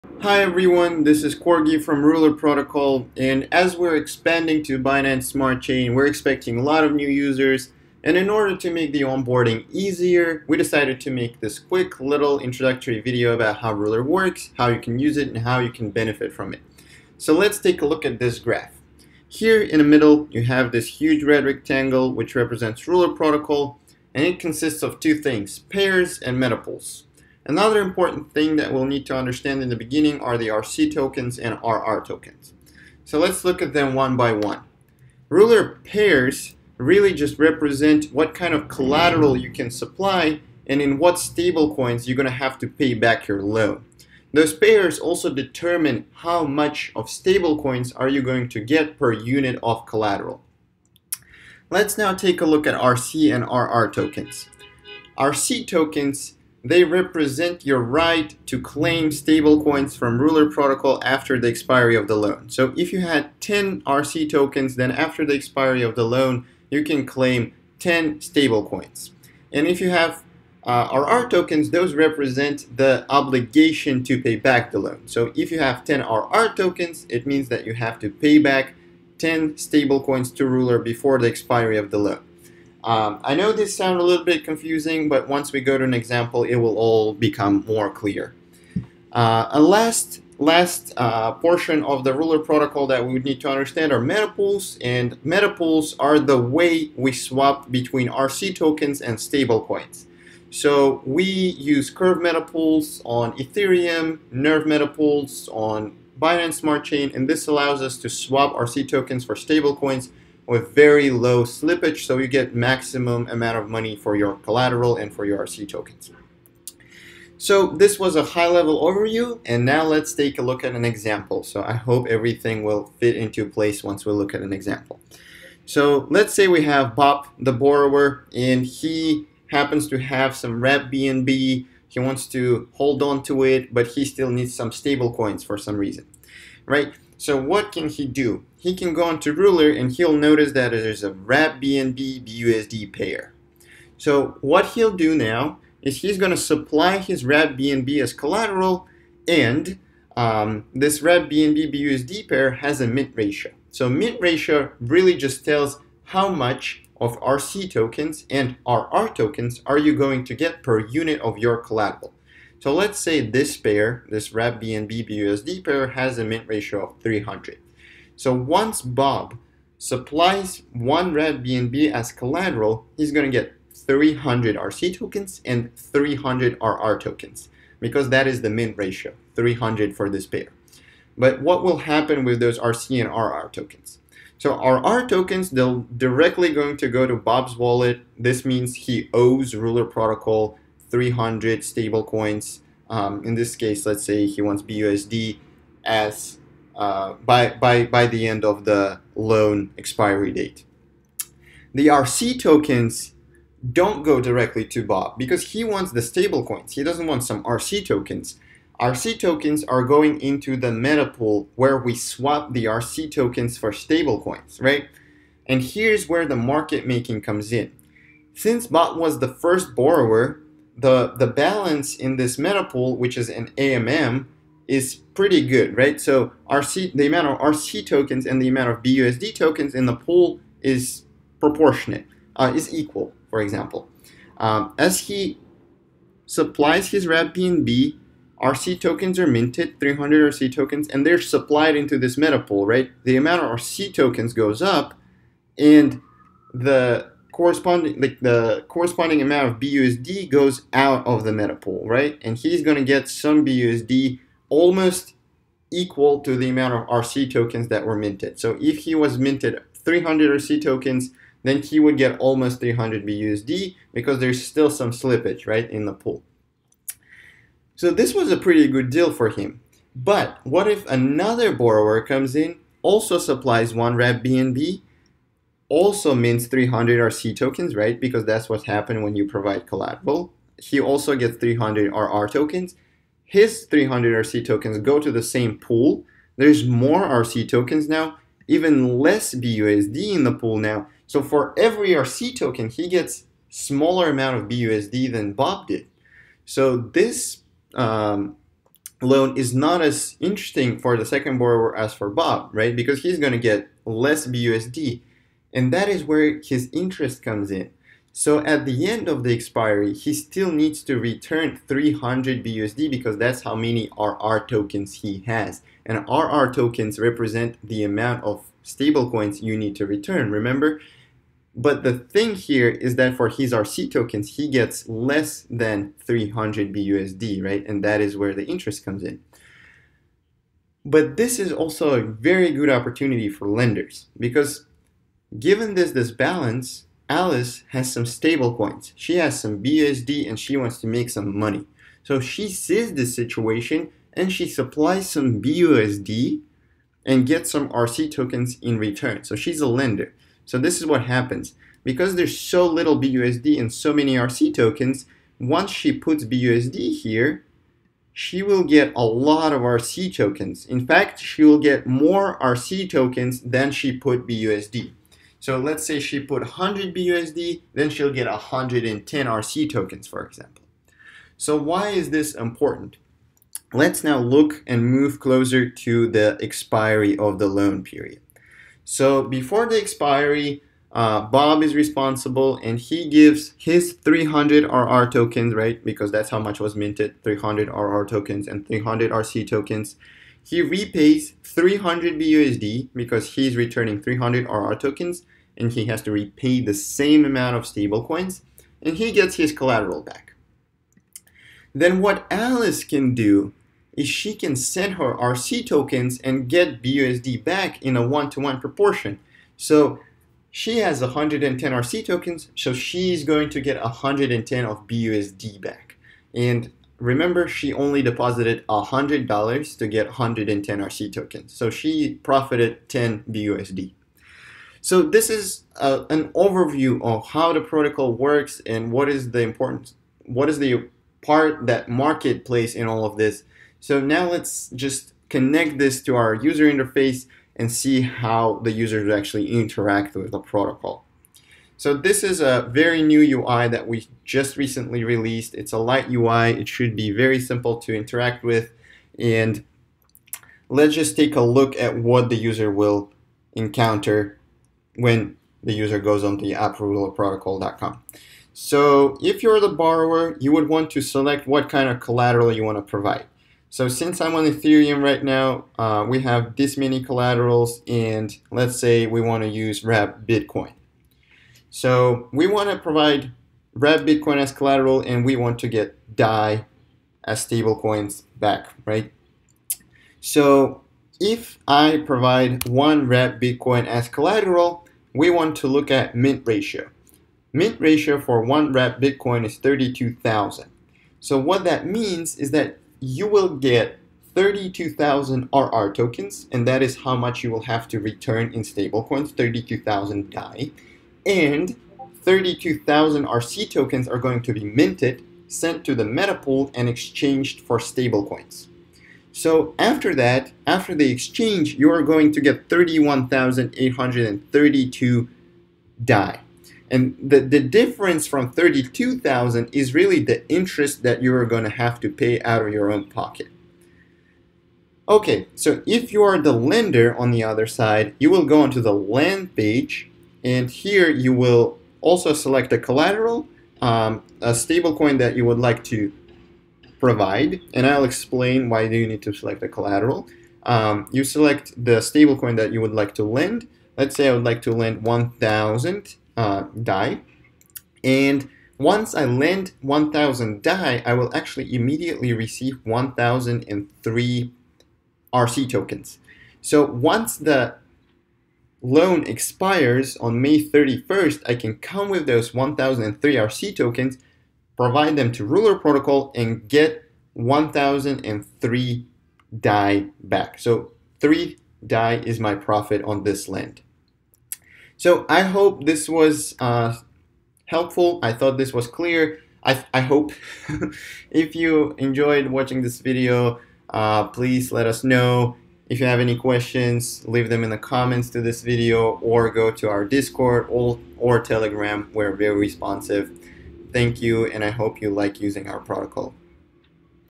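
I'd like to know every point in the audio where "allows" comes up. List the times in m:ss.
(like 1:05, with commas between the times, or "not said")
1:47.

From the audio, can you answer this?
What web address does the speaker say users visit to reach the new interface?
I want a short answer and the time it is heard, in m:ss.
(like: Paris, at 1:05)
app.rulerprotocol.com, at 7:36.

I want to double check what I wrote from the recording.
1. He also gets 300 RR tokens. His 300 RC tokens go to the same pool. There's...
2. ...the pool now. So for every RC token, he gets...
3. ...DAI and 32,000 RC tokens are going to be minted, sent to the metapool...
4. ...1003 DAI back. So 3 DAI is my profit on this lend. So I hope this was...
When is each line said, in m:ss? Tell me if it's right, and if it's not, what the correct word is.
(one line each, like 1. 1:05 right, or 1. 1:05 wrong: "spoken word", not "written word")
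1. 4:40 right
2. 4:50 right
3. 8:20 right
4. 9:27 right.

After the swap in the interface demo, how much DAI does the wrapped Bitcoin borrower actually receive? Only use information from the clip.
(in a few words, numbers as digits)
31,832 DAI.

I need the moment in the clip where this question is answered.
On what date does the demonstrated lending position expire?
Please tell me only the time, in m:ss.
9:20.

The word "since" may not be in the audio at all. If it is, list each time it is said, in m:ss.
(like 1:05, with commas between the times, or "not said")
3:38, 7:43.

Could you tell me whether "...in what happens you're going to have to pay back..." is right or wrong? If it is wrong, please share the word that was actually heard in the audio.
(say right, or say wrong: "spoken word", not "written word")
wrong: "stablecoins", not "happens".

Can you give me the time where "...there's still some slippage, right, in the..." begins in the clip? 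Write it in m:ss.
4:24.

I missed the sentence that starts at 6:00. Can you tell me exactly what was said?
In fact, she will get more RC tokens than she put BUSD.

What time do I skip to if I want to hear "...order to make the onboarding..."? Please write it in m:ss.
0:08.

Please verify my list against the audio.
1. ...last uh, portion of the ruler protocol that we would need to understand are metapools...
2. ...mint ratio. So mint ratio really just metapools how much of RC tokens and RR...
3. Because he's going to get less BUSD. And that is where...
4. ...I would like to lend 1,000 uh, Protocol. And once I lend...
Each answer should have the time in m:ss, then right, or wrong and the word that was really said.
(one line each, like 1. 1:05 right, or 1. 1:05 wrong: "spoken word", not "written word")
1. 1:30 right
2. 2:32 wrong: "tells", not "metapools"
3. 5:02 right
4. 9:04 wrong: "DAI", not "Protocol".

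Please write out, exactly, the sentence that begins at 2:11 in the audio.
He wants to hold on to it, but he still needs some stable coins for some reason, right?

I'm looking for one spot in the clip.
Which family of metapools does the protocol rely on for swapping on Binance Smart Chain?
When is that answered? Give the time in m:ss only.
1:44.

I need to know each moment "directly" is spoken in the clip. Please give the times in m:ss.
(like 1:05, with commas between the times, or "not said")
3:05, 3:24.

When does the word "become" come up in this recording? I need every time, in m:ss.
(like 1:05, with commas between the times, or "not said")
1:27.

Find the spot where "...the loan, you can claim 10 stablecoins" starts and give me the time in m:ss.
1:05.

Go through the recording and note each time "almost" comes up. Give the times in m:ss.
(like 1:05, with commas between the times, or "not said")
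4:14, 4:22.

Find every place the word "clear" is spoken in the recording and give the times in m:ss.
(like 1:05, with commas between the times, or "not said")
1:27, 9:38.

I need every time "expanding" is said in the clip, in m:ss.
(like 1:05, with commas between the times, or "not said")
0:03.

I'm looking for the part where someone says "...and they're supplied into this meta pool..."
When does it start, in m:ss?
4:00.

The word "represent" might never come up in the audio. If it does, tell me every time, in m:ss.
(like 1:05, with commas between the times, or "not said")
0:22, 0:37, 0:56, 1:11, 5:16.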